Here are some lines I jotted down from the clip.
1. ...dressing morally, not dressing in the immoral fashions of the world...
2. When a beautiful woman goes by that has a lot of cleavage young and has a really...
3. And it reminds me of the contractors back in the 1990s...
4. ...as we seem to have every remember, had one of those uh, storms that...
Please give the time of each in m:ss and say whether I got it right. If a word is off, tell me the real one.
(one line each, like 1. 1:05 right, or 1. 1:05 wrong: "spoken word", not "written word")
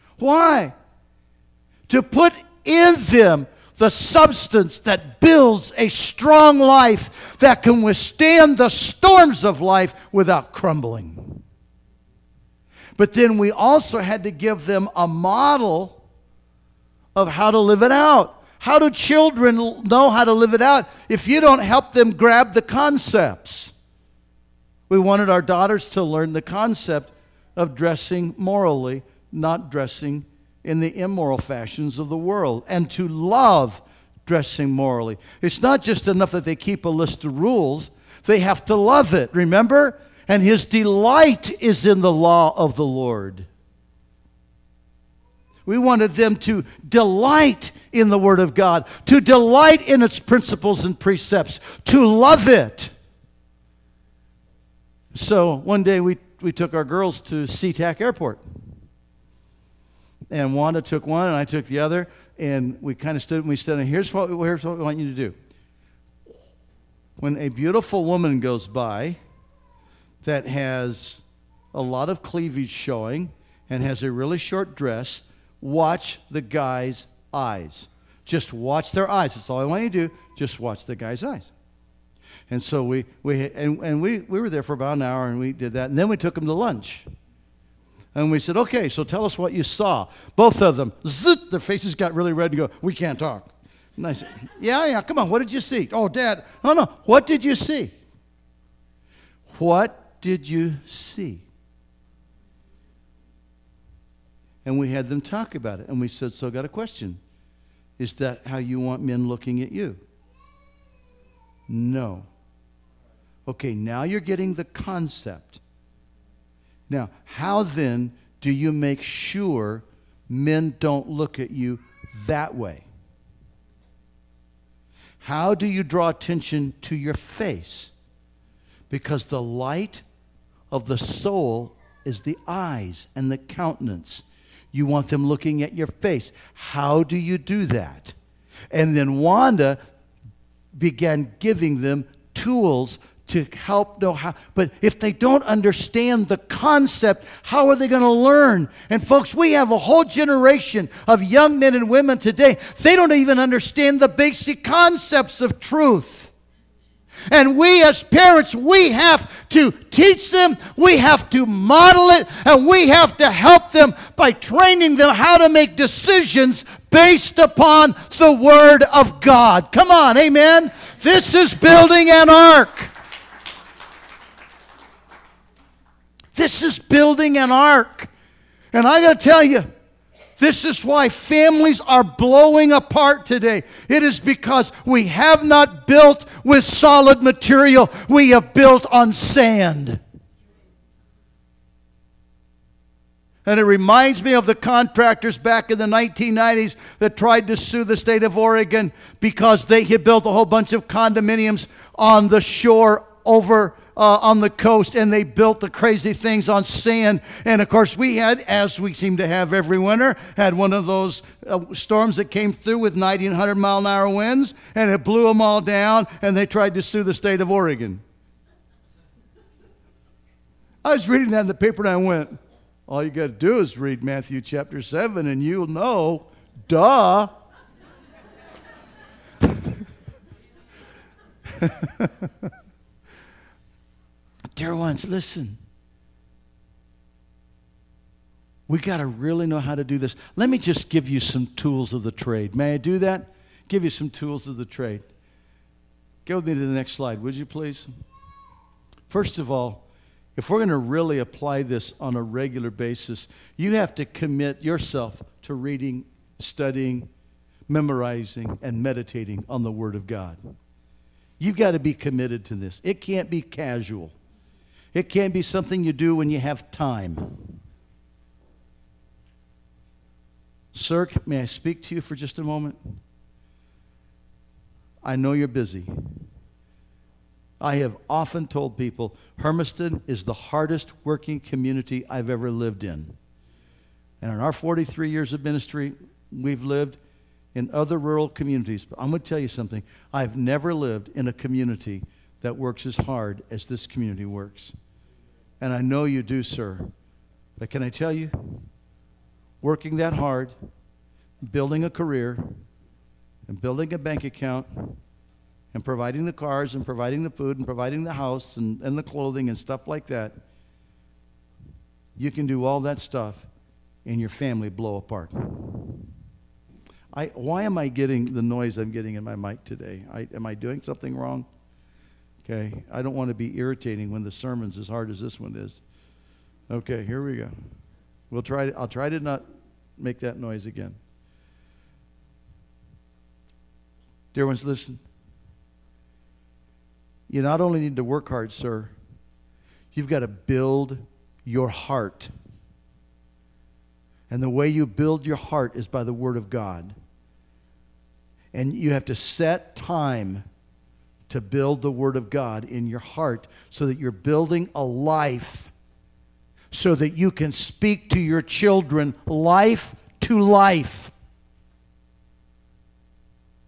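1. 0:27 right
2. 1:07 wrong: "showing", not "young"
3. 3:13 right
4. 3:28 wrong: "winter", not "remember".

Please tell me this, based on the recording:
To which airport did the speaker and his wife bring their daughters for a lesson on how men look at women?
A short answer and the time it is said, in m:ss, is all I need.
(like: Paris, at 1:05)
SeaTac Airport, at 0:57.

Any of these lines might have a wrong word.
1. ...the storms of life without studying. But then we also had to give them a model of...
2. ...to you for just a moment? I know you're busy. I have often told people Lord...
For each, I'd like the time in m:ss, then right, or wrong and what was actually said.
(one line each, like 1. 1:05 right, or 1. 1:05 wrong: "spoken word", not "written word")
1. 0:08 wrong: "crumbling", not "studying"
2. 4:31 wrong: "Hermiston", not "Lord".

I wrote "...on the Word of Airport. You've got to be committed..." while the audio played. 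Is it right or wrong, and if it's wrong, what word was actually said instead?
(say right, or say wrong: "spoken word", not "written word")
wrong: "God", not "Airport".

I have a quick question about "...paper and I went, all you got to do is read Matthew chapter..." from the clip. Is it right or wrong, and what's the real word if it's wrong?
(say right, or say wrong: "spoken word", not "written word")
right.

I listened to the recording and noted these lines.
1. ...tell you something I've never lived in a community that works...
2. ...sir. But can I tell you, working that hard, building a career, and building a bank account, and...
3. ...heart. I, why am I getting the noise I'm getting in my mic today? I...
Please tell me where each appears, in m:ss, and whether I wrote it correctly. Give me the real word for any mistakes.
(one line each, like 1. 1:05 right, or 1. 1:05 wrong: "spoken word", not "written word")
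1. 4:49 right
2. 4:56 right
3. 5:14 wrong: "apart", not "heart".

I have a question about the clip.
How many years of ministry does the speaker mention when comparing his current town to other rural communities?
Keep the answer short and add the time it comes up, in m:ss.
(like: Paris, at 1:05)
43, at 4:44.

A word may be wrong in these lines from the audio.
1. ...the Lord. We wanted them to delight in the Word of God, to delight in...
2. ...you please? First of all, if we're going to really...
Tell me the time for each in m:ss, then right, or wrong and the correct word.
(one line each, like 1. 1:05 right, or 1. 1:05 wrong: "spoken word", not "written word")
1. 0:42 right
2. 4:07 right.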